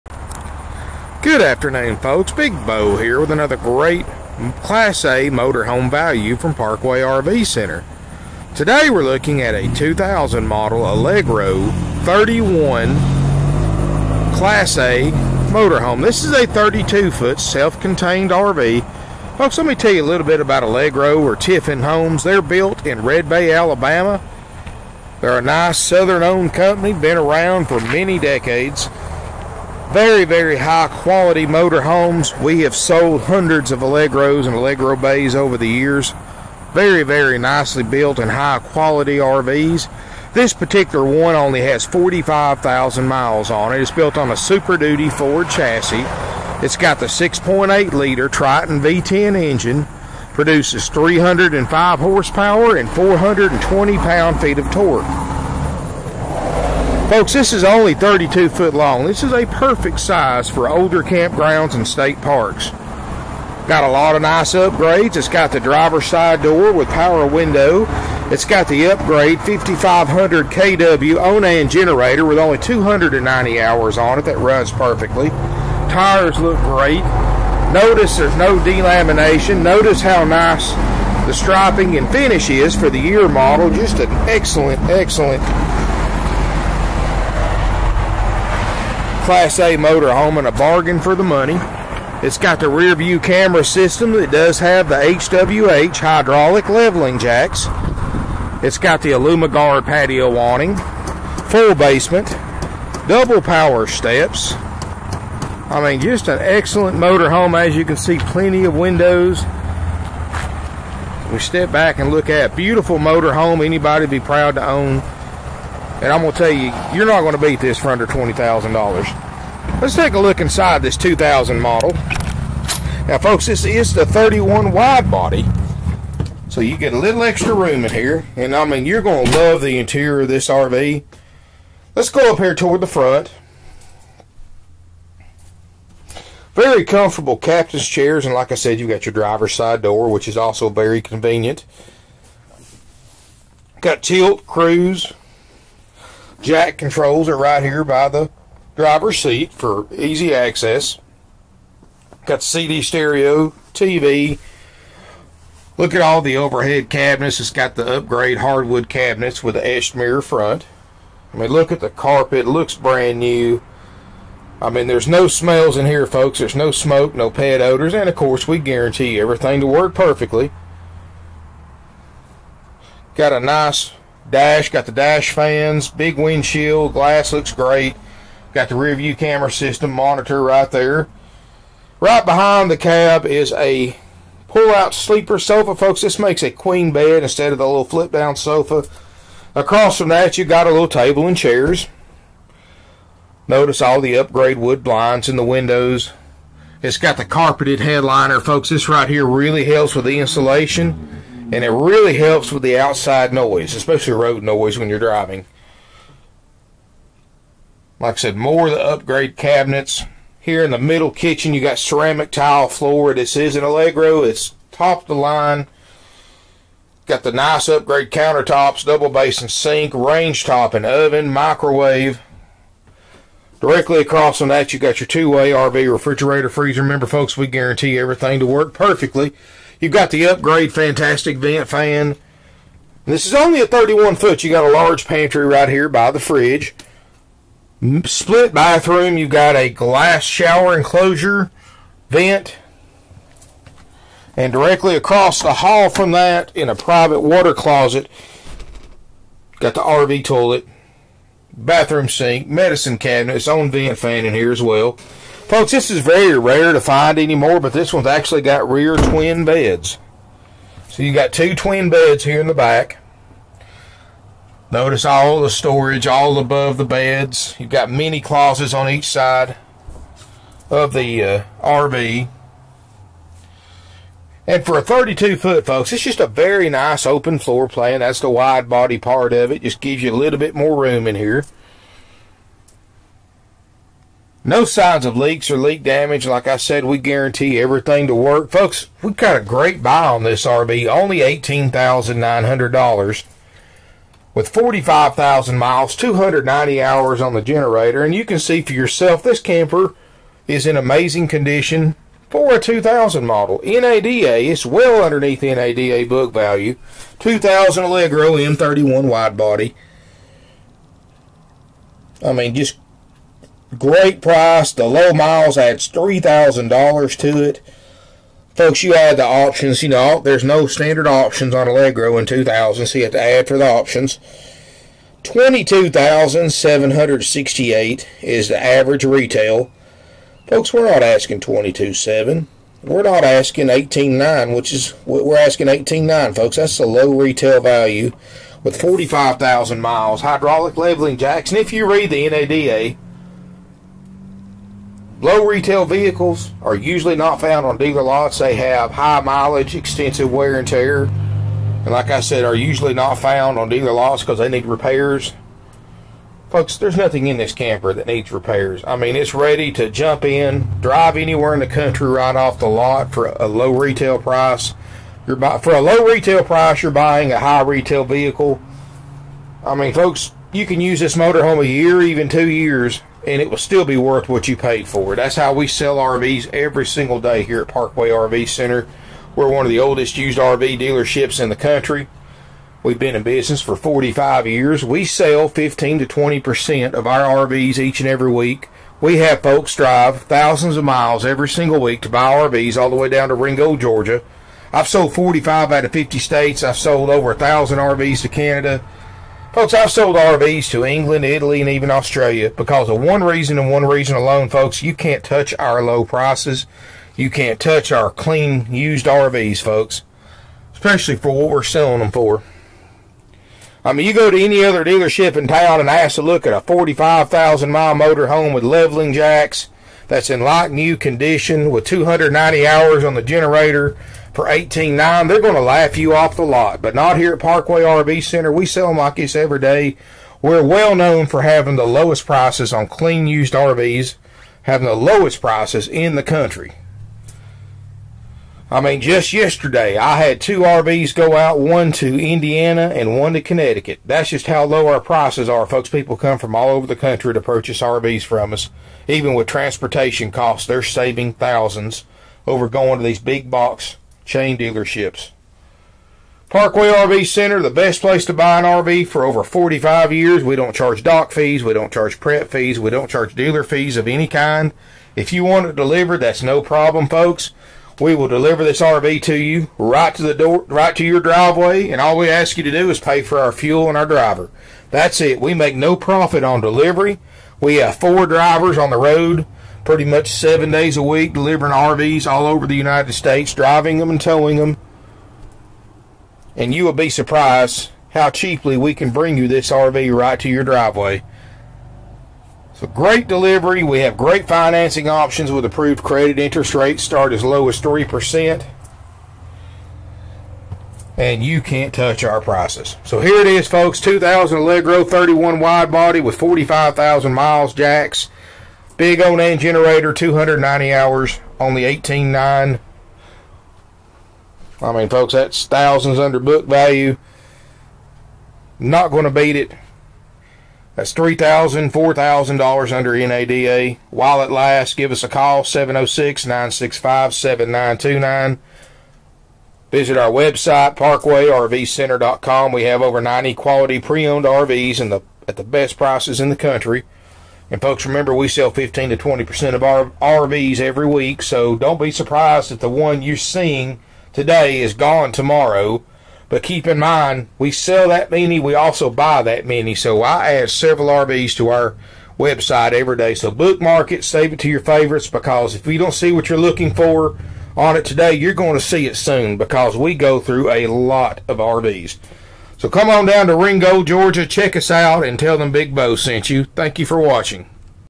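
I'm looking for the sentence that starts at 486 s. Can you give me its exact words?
And you will be surprised how cheaply we can bring you this RV right to your driveway.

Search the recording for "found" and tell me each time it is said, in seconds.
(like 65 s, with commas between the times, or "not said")
347 s, 353 s.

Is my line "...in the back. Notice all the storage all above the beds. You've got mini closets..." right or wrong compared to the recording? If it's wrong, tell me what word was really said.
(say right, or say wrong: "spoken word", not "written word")
right.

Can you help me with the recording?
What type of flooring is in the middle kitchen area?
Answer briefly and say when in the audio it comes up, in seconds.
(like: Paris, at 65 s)
Ceramic tile, at 211 s.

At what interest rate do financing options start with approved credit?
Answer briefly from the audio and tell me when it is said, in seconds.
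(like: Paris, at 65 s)
3%, at 497 s.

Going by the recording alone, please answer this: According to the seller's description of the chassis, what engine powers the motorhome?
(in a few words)
6.8 liter Triton V10.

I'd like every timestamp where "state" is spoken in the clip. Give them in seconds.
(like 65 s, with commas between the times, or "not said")
61 s, 396 s, 483 s.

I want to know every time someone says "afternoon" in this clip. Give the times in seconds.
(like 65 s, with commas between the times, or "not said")
1 s.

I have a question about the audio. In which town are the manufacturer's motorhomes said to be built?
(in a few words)
Red Bay, Alabama.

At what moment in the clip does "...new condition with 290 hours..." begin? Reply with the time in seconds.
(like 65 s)
420 s.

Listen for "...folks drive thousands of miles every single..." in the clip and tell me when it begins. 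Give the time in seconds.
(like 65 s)
389 s.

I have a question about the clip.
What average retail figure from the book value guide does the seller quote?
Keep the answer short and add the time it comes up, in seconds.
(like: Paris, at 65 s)
$22,768, at 325 s.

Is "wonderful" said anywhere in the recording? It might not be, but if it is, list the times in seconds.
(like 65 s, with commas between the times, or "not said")
not said.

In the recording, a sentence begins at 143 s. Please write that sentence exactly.
Got tilt, cruise, Jack controls are right here by the driver's seat for easy access.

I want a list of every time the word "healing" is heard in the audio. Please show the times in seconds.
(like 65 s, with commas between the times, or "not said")
not said.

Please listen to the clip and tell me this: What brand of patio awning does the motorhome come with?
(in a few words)
Aluma Guard.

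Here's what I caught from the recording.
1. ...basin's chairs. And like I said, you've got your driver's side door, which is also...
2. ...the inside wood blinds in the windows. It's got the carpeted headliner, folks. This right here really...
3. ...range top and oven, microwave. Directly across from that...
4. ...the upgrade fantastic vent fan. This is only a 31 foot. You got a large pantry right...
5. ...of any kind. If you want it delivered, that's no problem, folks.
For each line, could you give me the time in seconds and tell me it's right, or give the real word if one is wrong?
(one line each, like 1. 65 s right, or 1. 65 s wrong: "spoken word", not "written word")
1. 137 s wrong: "captain", not "basin"
2. 194 s wrong: "upgrade", not "inside"
3. 219 s right
4. 230 s right
5. 463 s right.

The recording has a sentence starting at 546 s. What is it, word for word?
But keep in mind, we sell that many, we also buy that many.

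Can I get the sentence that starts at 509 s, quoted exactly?
Big old name generator, 290 hours, on the 18.9.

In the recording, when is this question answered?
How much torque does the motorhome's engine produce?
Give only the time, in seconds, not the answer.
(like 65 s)
52 s.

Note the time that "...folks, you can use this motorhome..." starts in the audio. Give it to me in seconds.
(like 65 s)
369 s.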